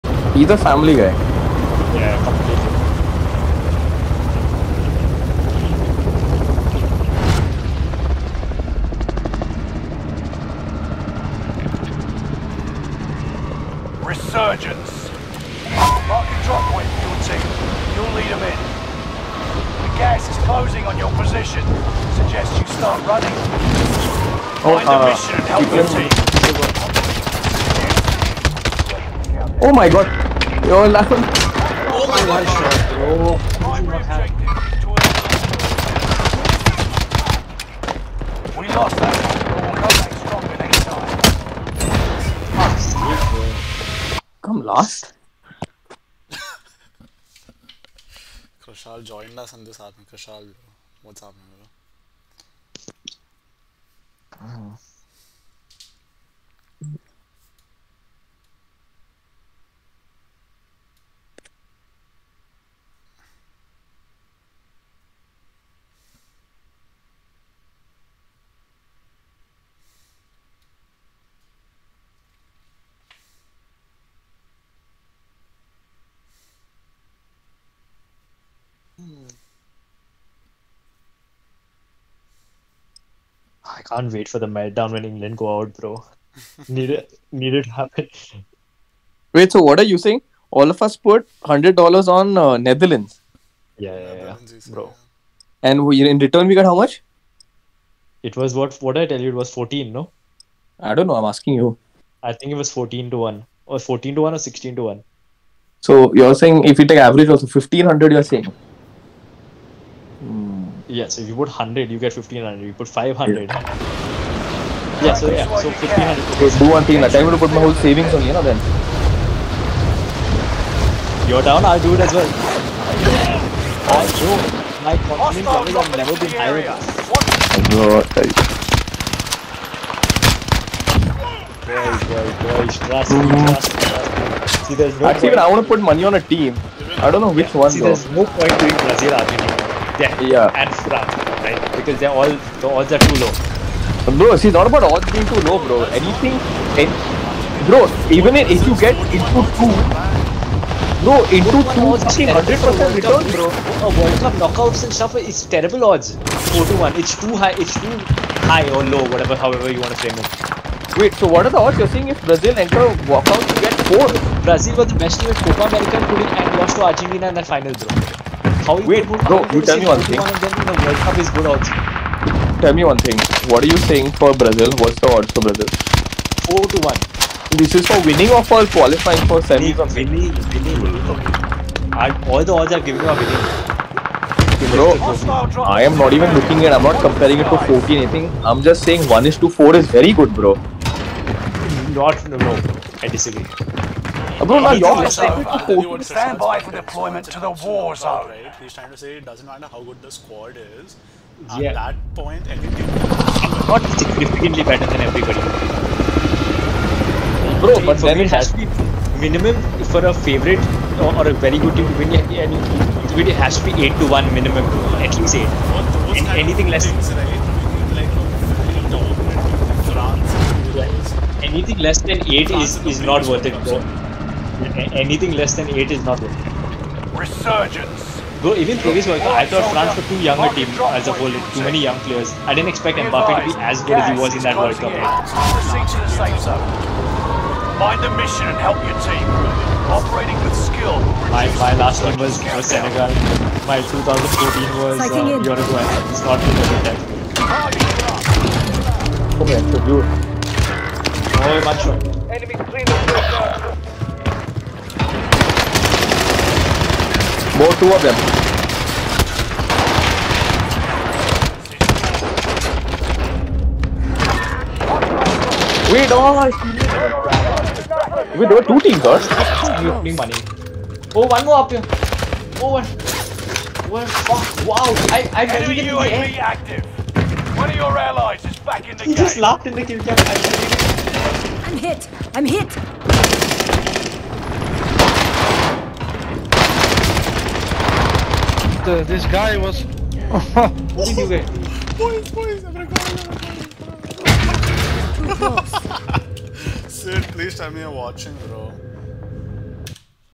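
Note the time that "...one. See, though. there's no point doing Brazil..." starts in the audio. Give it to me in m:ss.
2:17.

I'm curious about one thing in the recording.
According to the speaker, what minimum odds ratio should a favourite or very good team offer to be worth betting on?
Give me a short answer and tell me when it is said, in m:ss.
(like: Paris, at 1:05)
8 to 1, at 3:33.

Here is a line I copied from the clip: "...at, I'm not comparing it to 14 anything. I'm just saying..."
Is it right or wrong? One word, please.
right.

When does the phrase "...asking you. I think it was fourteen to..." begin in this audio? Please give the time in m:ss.
1:41.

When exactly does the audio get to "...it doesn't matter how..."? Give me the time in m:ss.
3:19.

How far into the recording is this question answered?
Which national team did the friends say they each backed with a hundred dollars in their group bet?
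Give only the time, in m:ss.
1:32.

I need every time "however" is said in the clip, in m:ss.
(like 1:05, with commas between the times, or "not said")
2:39.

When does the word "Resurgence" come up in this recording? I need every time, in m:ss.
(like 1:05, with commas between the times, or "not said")
0:14, 3:47.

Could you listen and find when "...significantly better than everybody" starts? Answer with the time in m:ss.
3:23.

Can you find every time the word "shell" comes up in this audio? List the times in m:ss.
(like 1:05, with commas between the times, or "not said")
not said.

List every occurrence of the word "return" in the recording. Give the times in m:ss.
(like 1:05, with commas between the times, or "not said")
1:36, 2:32.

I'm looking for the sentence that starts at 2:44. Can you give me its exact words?
Brazil was the best team at Copa America and lost to Argentina in that final, bro.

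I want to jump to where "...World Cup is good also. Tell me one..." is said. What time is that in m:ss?
2:50.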